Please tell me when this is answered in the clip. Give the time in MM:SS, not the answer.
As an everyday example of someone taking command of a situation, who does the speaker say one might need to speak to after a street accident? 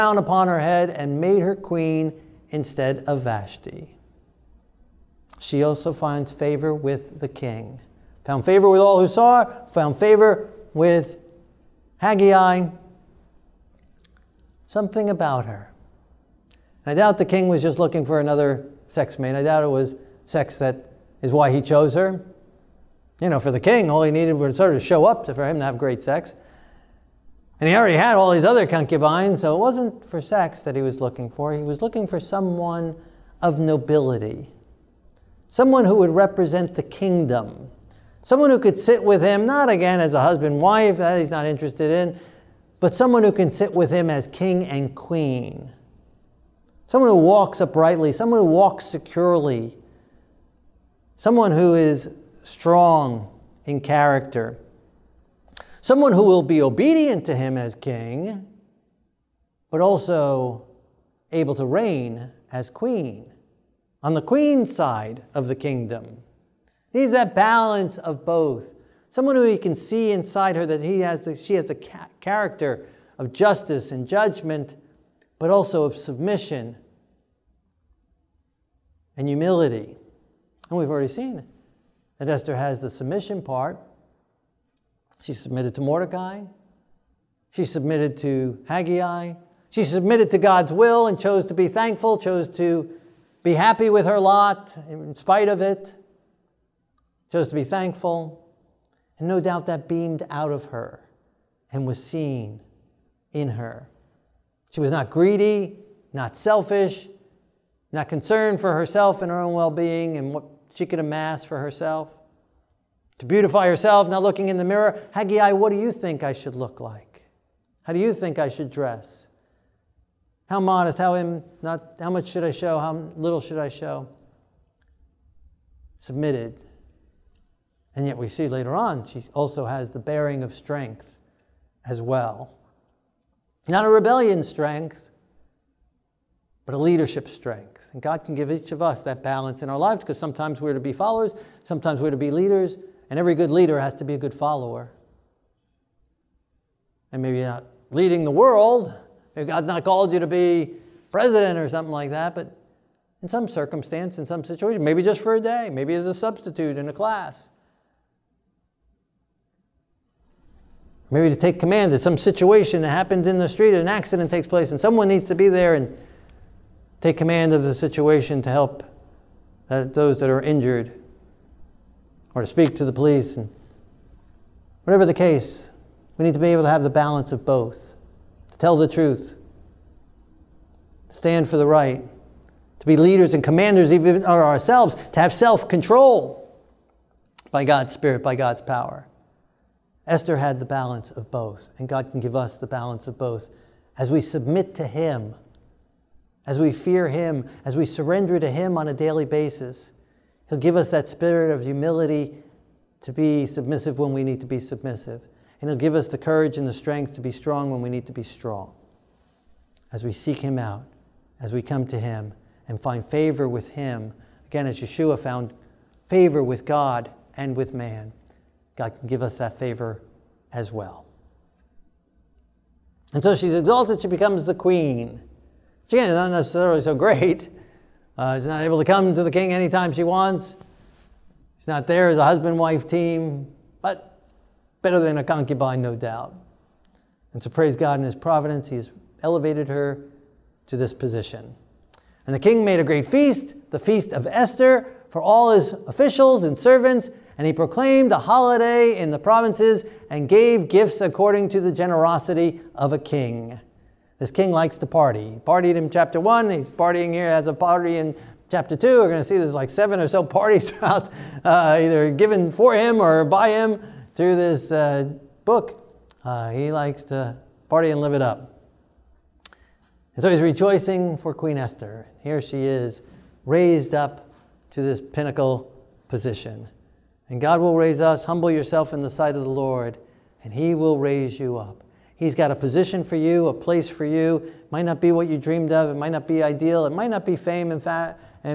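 02:52.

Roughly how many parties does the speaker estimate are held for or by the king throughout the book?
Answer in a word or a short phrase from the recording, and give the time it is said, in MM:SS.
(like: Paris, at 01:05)
7, at 04:19.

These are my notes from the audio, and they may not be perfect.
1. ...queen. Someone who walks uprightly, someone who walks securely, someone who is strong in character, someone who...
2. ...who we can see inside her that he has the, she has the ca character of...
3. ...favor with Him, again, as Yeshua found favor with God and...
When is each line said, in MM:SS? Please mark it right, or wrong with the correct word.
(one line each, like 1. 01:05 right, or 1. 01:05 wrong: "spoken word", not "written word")
1. 00:44 right
2. 01:09 right
3. 03:33 right.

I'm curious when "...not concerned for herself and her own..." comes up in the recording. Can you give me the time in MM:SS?
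01:47.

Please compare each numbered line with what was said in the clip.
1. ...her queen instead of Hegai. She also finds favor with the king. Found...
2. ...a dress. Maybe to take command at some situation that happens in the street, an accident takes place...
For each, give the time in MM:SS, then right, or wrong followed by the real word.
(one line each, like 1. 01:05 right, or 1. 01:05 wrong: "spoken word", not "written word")
1. 00:01 wrong: "Vashti", not "Hegai"
2. 02:36 wrong: "class", not "dress".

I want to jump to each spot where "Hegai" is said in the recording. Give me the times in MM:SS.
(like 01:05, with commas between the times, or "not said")
00:12, 01:28, 01:55.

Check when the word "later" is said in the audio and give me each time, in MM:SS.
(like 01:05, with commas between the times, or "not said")
02:08.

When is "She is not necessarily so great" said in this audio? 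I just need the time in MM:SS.
03:45.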